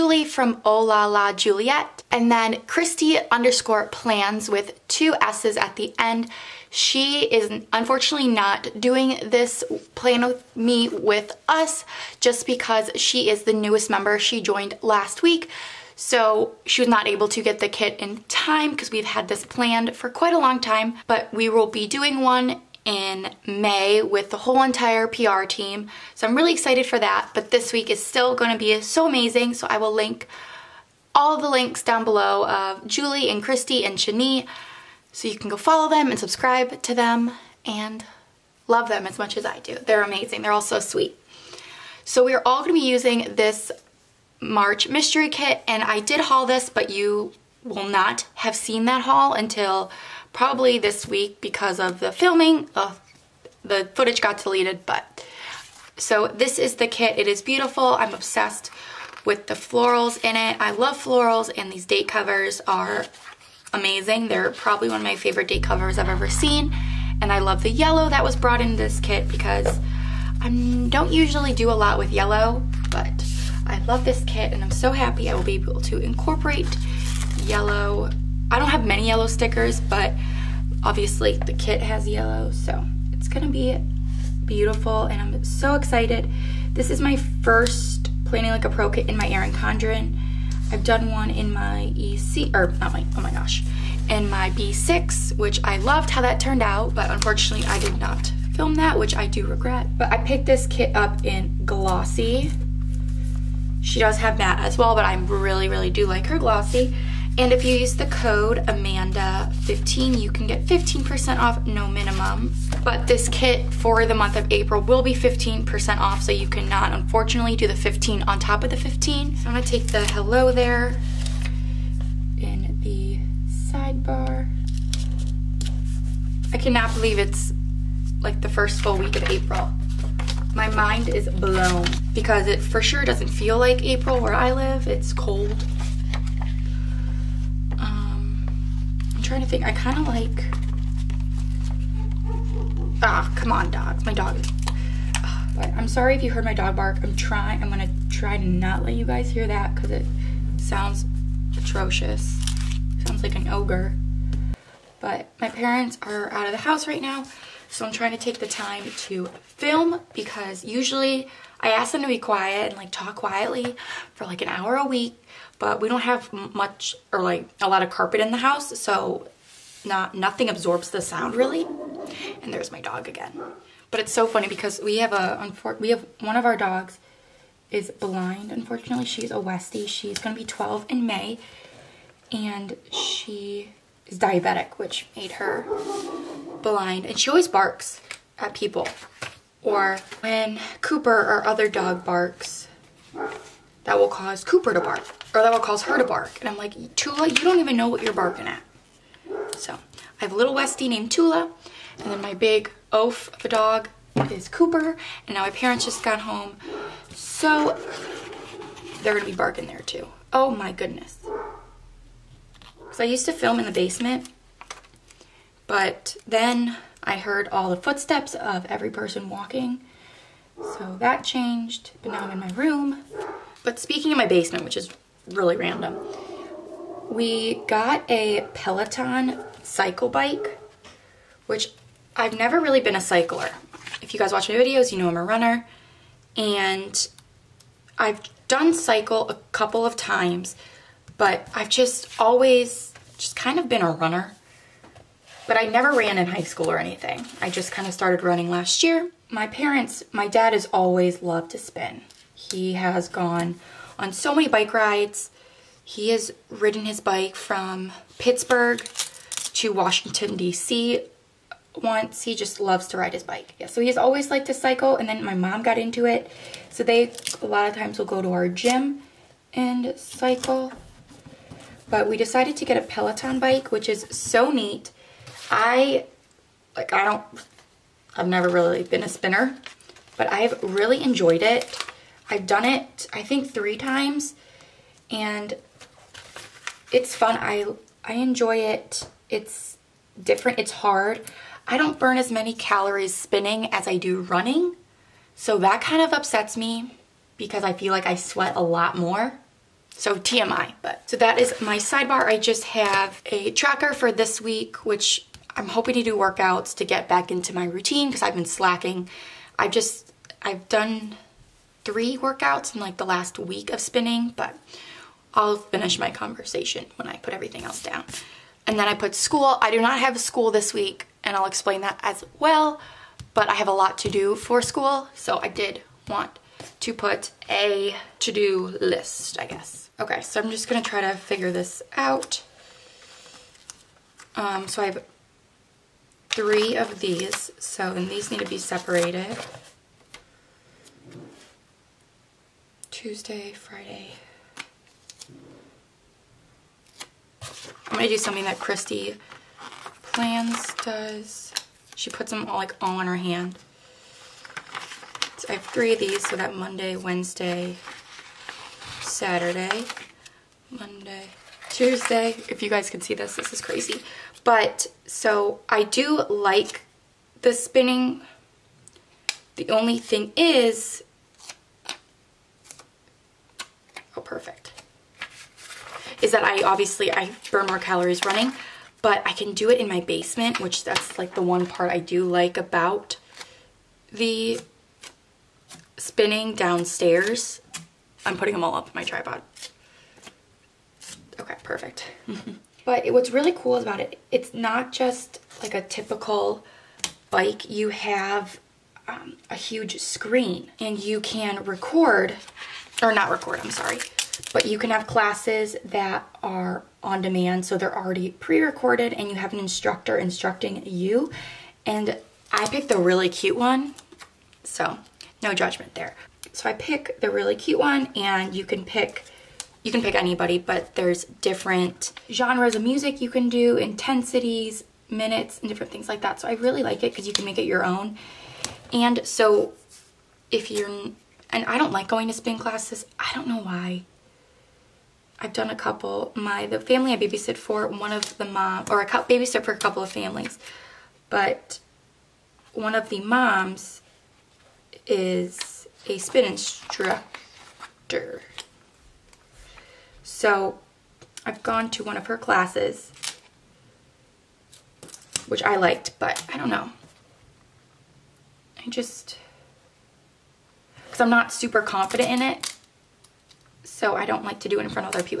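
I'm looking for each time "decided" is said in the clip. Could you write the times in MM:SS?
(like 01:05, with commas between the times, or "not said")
04:32.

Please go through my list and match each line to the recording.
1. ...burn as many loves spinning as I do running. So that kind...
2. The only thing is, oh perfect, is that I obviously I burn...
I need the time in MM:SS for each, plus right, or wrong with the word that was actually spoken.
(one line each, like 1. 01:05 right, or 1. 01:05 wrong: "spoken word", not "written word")
1. 04:51 wrong: "calories", not "loves"
2. 06:09 right.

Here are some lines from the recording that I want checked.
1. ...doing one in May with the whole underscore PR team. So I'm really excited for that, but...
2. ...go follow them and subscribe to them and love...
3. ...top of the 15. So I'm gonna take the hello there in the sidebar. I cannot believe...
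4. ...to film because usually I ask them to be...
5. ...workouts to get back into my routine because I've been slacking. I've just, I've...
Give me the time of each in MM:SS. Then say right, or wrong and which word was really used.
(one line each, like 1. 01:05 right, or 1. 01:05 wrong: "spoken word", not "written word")
1. 00:21 wrong: "entire", not "underscore"
2. 00:35 right
3. 01:58 right
4. 02:39 right
5. 05:06 right.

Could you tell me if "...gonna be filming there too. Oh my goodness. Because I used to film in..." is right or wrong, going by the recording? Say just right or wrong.
wrong.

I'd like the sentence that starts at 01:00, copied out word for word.
I love florals and these date covers are amazing.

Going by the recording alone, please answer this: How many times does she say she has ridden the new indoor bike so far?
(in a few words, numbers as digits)
3.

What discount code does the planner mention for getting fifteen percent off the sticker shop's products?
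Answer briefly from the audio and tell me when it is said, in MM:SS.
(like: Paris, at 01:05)
AMANDA15, at 01:48.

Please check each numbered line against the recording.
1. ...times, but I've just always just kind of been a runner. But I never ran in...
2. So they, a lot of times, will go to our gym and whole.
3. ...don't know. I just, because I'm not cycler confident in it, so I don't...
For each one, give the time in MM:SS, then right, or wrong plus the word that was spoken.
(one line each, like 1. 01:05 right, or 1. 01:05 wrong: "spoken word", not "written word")
1. 03:59 right
2. 04:26 wrong: "cycle", not "whole"
3. 07:36 wrong: "super", not "cycler".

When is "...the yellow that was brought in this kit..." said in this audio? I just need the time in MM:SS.
01:07.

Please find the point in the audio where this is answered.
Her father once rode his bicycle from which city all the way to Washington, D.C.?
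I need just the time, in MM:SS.
04:18.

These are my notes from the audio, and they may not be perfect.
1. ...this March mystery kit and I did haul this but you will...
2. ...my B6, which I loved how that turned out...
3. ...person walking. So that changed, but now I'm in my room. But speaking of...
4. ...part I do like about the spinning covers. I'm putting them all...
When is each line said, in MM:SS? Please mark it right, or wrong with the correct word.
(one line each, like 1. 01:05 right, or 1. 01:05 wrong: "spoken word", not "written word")
1. 00:43 right
2. 01:34 right
3. 03:38 right
4. 06:21 wrong: "downstairs", not "covers".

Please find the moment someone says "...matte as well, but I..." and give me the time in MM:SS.
01:44.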